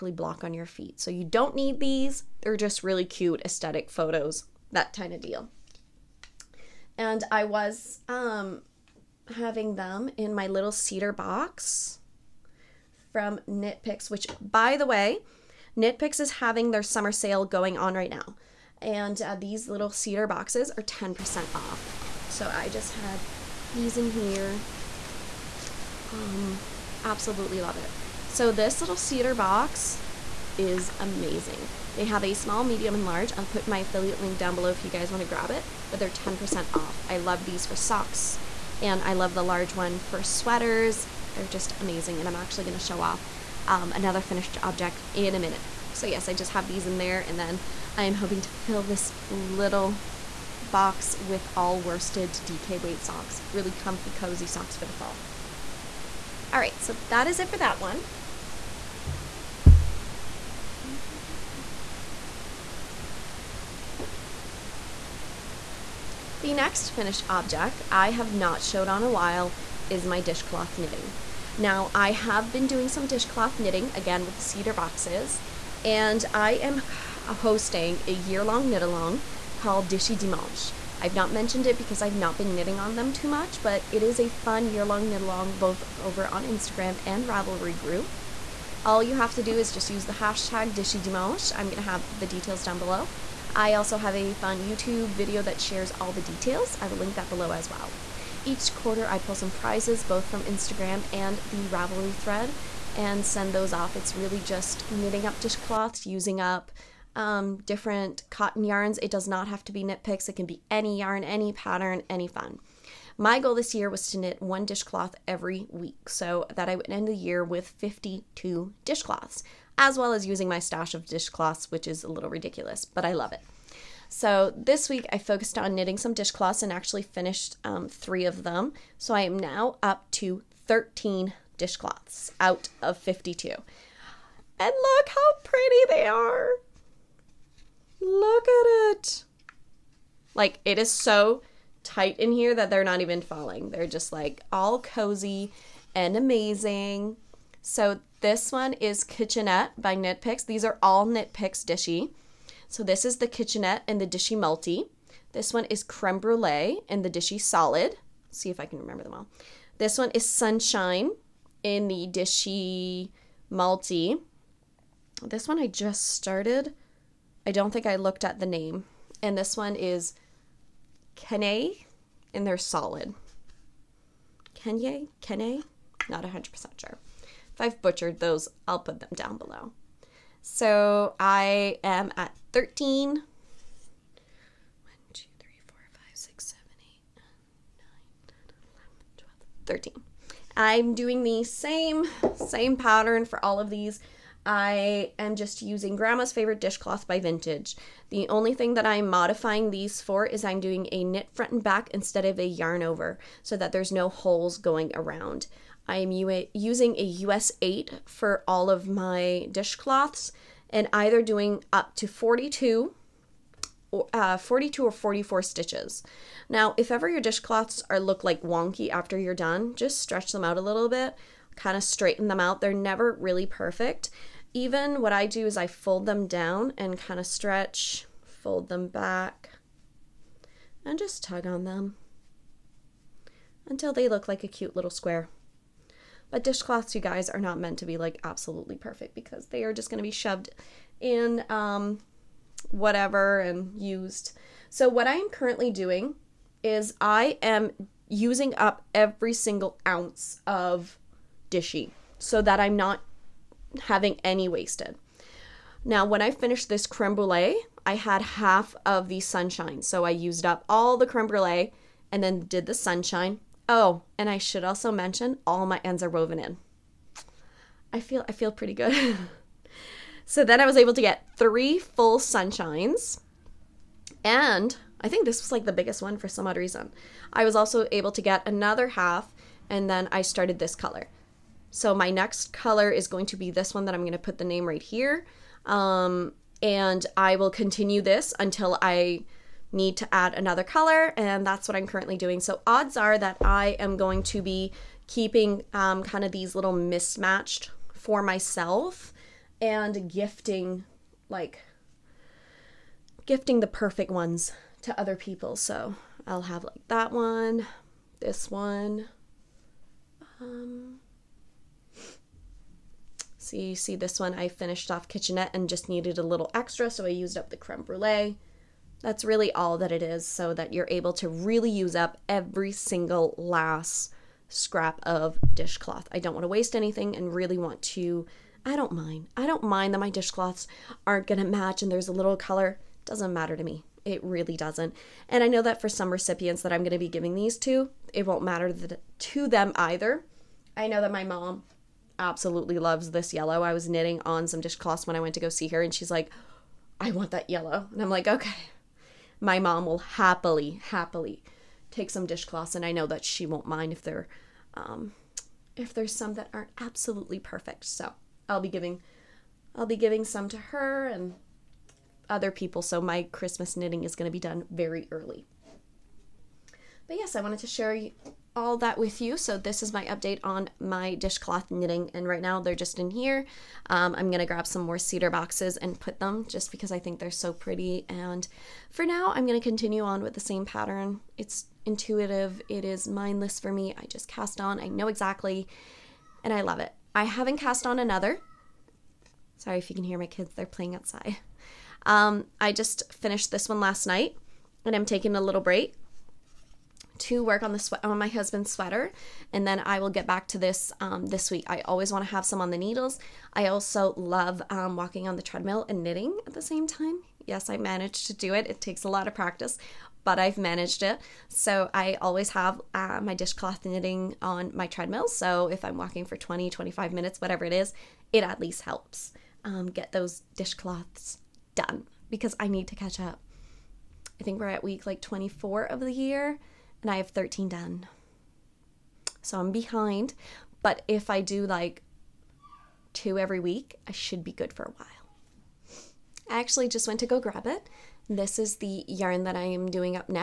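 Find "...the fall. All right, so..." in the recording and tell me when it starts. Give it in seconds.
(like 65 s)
54 s.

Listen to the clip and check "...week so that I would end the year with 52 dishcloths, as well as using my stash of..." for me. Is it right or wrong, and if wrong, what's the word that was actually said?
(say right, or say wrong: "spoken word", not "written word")
right.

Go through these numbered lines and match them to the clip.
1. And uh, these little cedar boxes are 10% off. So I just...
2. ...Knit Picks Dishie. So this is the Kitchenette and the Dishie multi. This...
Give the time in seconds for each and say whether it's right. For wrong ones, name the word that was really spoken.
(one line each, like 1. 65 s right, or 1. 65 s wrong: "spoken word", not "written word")
1. 18 s right
2. 151 s right.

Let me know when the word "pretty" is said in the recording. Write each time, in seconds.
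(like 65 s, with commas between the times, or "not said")
135 s, 268 s, 377 s.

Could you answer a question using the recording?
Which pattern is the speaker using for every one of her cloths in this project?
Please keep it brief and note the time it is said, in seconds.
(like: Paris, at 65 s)
Grandma's Favorite Dishcloth, at 195 s.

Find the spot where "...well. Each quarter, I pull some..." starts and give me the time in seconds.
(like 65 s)
97 s.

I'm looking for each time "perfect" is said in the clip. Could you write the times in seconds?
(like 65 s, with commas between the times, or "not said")
223 s, 238 s, 303 s, 357 s.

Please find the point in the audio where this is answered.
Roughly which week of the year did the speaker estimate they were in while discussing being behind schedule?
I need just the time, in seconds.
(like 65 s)
424 s.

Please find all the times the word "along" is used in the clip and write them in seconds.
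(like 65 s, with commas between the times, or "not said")
78 s, 85 s.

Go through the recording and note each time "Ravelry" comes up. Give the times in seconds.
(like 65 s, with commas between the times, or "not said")
87 s, 101 s.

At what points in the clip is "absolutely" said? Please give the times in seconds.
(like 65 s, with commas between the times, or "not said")
27 s, 238 s, 342 s, 356 s.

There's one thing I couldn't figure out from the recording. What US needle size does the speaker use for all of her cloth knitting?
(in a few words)
US 8.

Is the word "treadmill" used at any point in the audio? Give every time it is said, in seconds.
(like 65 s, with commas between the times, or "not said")
405 s, 414 s.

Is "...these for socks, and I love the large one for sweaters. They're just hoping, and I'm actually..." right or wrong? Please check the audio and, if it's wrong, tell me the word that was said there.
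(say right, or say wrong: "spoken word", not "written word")
wrong: "amazing", not "hoping".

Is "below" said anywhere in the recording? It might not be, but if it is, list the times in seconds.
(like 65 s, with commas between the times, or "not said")
34 s, 92 s, 97 s, 179 s.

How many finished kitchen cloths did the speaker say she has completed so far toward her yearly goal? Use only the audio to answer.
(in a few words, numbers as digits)
13.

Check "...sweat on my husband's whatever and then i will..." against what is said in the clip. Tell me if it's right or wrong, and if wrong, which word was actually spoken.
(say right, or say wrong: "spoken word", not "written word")
wrong: "sweater", not "whatever".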